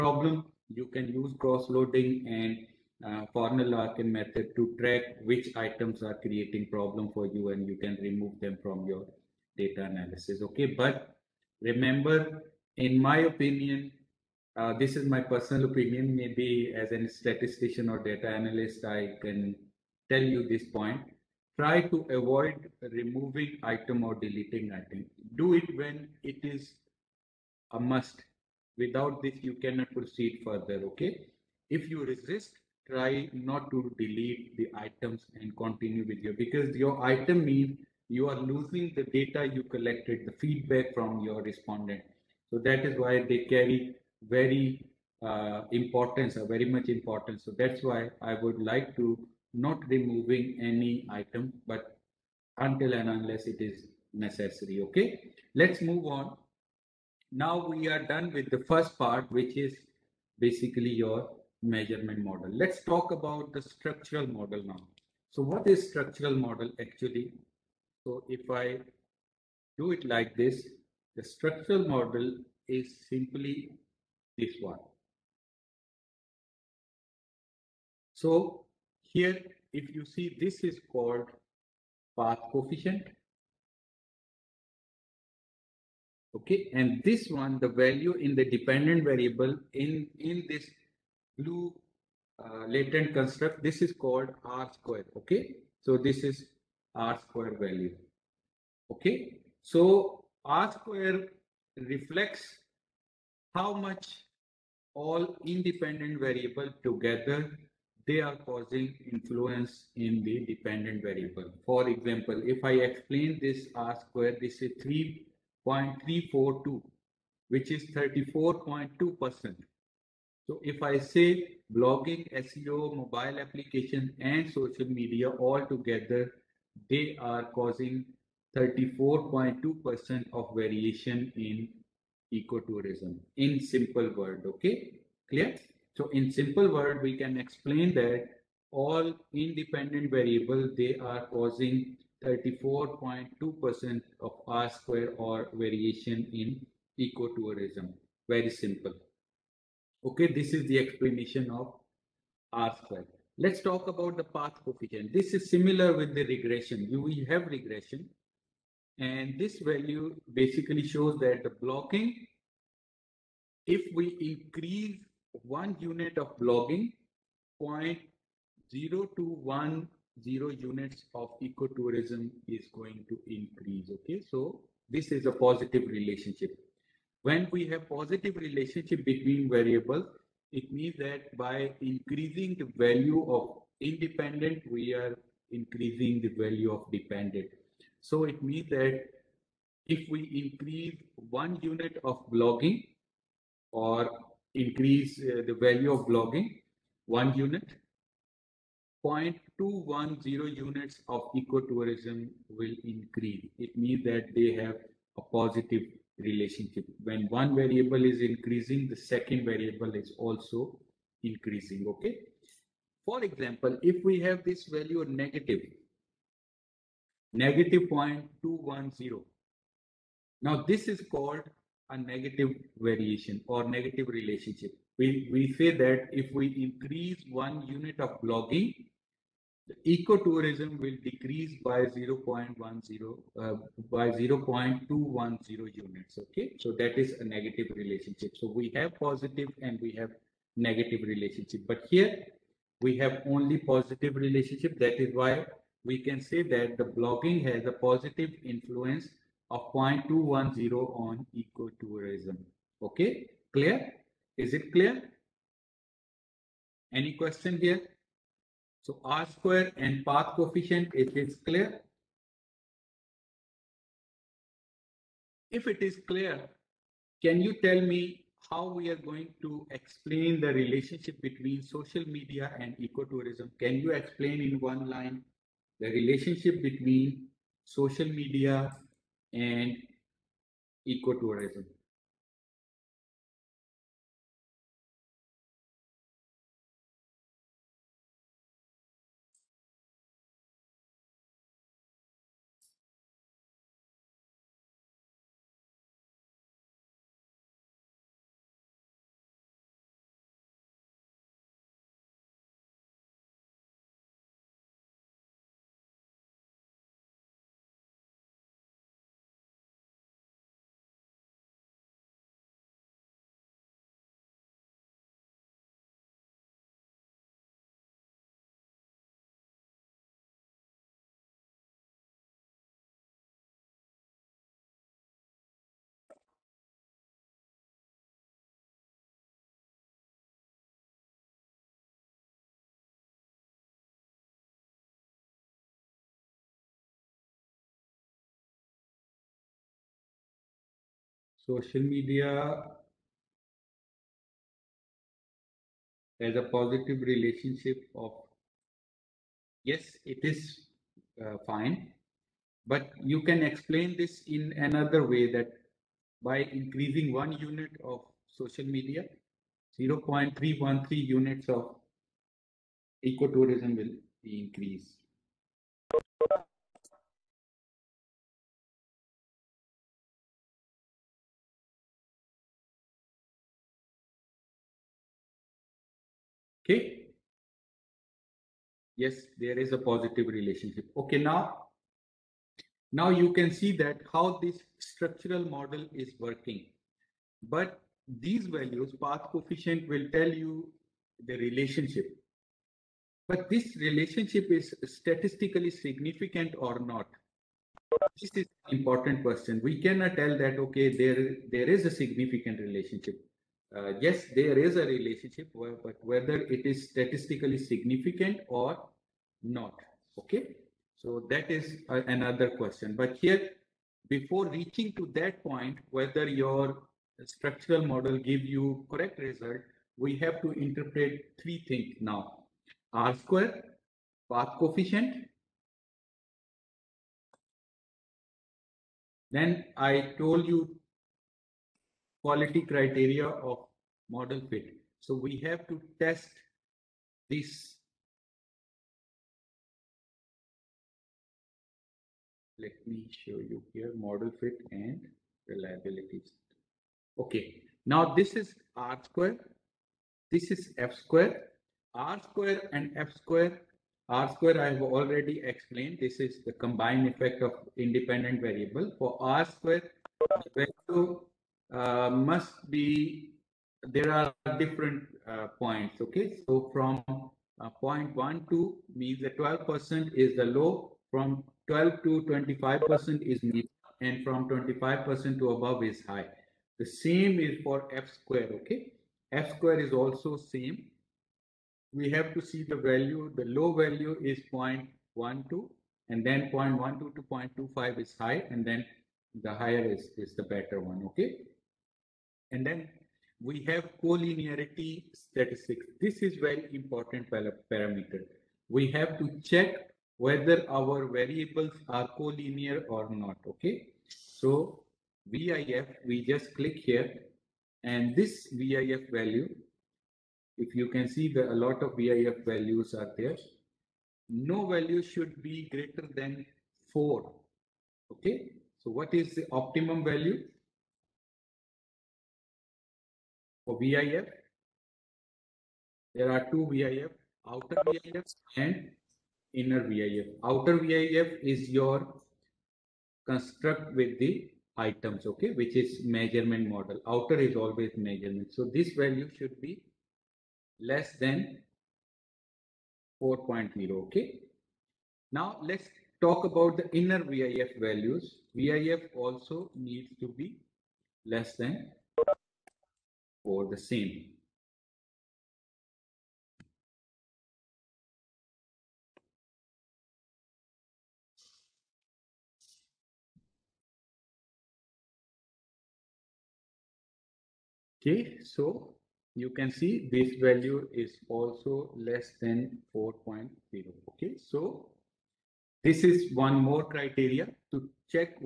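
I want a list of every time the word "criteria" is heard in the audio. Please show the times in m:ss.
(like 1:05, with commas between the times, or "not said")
7:12, 9:36.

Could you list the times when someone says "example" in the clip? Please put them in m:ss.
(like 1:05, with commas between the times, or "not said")
1:51, 3:33.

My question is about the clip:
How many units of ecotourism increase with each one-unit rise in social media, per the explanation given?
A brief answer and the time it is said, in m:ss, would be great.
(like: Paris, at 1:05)
0.313, at 5:59.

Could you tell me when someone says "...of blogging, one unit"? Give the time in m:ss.
3:15.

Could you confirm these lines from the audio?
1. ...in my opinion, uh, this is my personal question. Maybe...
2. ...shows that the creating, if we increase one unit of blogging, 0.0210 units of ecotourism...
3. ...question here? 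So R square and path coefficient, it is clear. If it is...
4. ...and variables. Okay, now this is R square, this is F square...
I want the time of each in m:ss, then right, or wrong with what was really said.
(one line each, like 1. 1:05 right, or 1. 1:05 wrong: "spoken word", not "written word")
1. 0:12 wrong: "opinion", not "question"
2. 2:40 wrong: "blogging", not "creating"
3. 4:17 right
4. 7:24 wrong: "reliabilities", not "variables".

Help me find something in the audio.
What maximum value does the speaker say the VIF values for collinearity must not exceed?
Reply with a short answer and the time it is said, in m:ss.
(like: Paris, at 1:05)
4, at 8:36.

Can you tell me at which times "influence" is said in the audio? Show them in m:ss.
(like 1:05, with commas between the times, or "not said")
1:49, 4:08.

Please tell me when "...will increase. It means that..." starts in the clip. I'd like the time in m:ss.
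3:22.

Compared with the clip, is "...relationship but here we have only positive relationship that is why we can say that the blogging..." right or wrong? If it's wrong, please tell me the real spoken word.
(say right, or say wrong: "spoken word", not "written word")
right.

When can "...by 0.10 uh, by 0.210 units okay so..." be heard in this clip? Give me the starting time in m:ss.
3:51.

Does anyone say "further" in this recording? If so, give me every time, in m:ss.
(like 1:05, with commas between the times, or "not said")
0:30.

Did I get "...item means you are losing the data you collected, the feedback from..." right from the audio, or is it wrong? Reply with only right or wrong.
right.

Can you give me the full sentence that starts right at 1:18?
So here, if you see, this is called path coefficient.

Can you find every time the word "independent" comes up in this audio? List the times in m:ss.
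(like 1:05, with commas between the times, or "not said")
1:45, 2:19, 3:03, 7:37.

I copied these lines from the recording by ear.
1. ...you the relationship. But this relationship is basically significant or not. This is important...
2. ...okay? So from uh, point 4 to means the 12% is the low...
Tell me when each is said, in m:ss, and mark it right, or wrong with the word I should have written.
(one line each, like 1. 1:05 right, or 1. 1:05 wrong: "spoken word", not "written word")
1. 6:30 wrong: "statistically", not "basically"
2. 7:45 wrong: "1", not "4".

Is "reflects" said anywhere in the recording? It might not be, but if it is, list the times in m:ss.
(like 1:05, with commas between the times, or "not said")
1:41.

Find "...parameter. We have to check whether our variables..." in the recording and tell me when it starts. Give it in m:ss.
8:17.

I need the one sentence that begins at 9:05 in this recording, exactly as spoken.
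Now let's talk about the inner VIF values.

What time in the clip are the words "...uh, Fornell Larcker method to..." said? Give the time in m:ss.
0:03.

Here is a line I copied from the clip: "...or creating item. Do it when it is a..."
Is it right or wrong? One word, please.
wrong.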